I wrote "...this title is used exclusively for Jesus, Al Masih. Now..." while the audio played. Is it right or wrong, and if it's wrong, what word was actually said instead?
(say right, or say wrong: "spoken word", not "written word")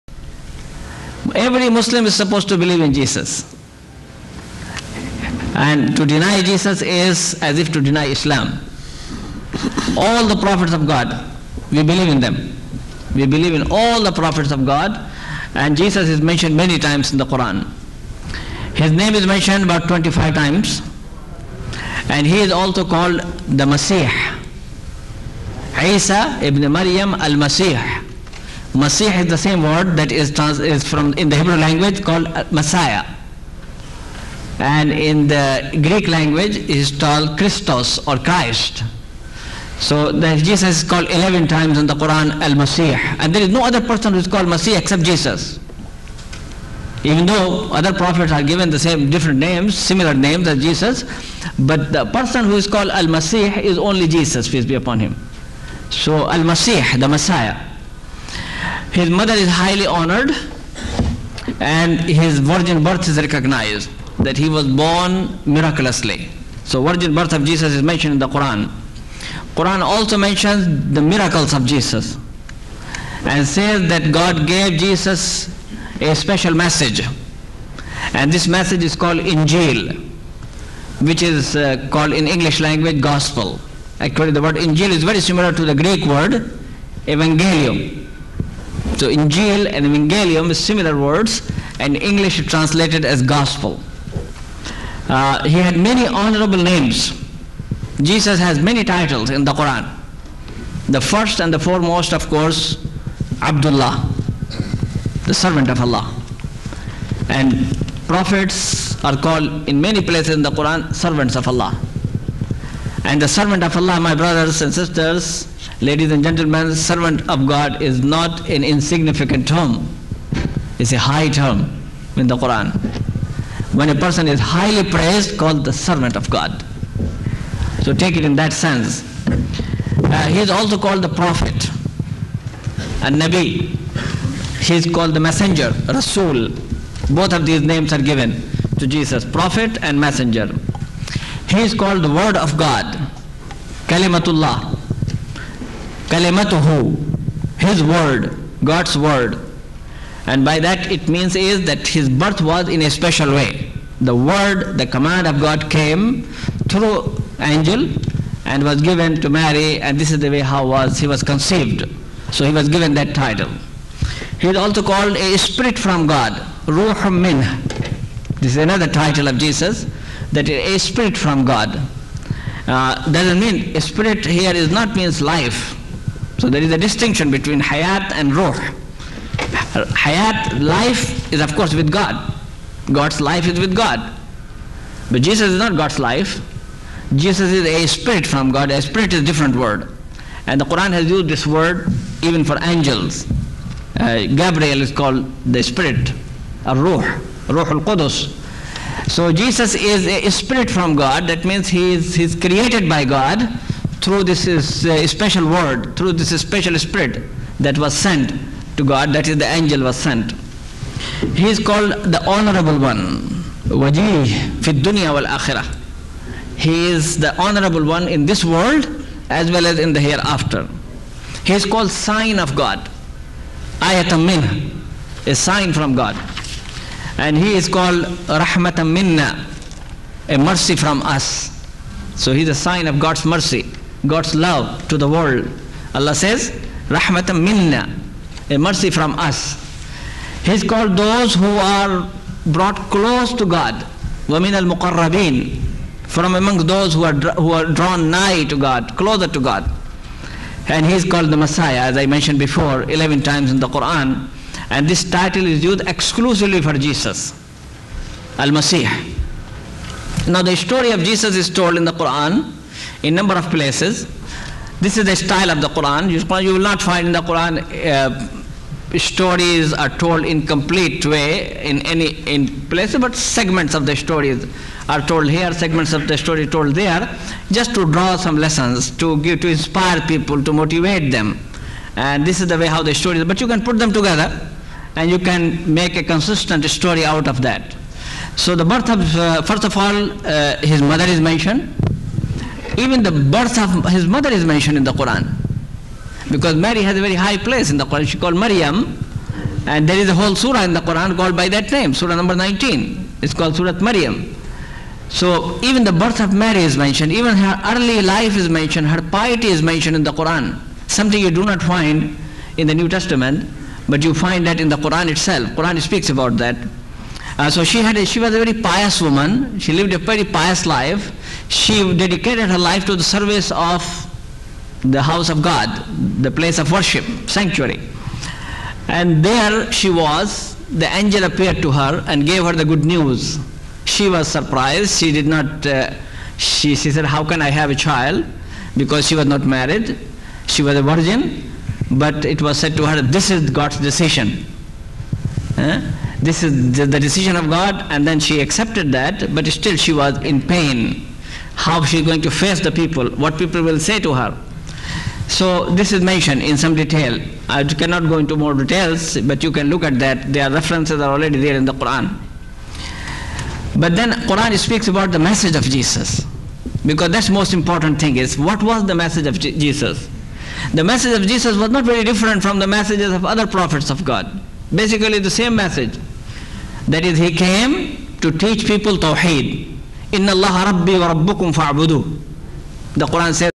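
right.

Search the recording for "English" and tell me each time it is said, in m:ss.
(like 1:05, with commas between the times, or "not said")
1:22, 1:31.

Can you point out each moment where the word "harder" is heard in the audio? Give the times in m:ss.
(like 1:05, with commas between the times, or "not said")
not said.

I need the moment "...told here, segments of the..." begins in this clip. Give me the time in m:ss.
4:35.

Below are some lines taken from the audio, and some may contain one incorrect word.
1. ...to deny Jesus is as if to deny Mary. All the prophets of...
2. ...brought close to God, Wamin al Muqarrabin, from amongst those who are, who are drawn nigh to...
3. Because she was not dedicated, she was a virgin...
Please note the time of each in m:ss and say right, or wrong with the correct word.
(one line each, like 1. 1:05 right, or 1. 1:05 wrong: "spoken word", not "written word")
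1. 0:05 wrong: "Islam", not "Mary"
2. 4:02 right
3. 5:38 wrong: "married", not "dedicated".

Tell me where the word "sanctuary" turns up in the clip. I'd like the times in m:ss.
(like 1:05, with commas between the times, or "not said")
5:27.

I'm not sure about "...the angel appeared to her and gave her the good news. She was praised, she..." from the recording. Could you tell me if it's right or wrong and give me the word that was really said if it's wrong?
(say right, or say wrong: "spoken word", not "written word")
wrong: "surprised", not "praised".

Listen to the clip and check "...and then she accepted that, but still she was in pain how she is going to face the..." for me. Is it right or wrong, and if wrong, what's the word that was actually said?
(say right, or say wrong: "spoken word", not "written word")
right.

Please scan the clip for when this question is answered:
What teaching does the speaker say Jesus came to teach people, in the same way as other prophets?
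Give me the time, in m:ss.
6:18.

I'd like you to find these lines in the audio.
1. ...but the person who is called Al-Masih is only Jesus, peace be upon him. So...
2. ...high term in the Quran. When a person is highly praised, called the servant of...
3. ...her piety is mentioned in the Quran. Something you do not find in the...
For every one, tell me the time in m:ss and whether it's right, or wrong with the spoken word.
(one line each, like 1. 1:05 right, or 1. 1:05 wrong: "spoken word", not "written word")
1. 0:51 right
2. 2:00 right
3. 5:08 right.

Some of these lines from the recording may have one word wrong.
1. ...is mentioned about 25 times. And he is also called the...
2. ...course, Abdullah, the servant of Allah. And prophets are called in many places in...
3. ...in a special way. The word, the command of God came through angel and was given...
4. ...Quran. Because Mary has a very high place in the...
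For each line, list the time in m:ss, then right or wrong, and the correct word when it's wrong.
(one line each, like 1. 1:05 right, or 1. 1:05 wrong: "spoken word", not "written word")
1. 0:19 right
2. 1:42 right
3. 2:32 right
4. 4:54 right.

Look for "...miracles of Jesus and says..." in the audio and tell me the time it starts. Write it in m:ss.
1:11.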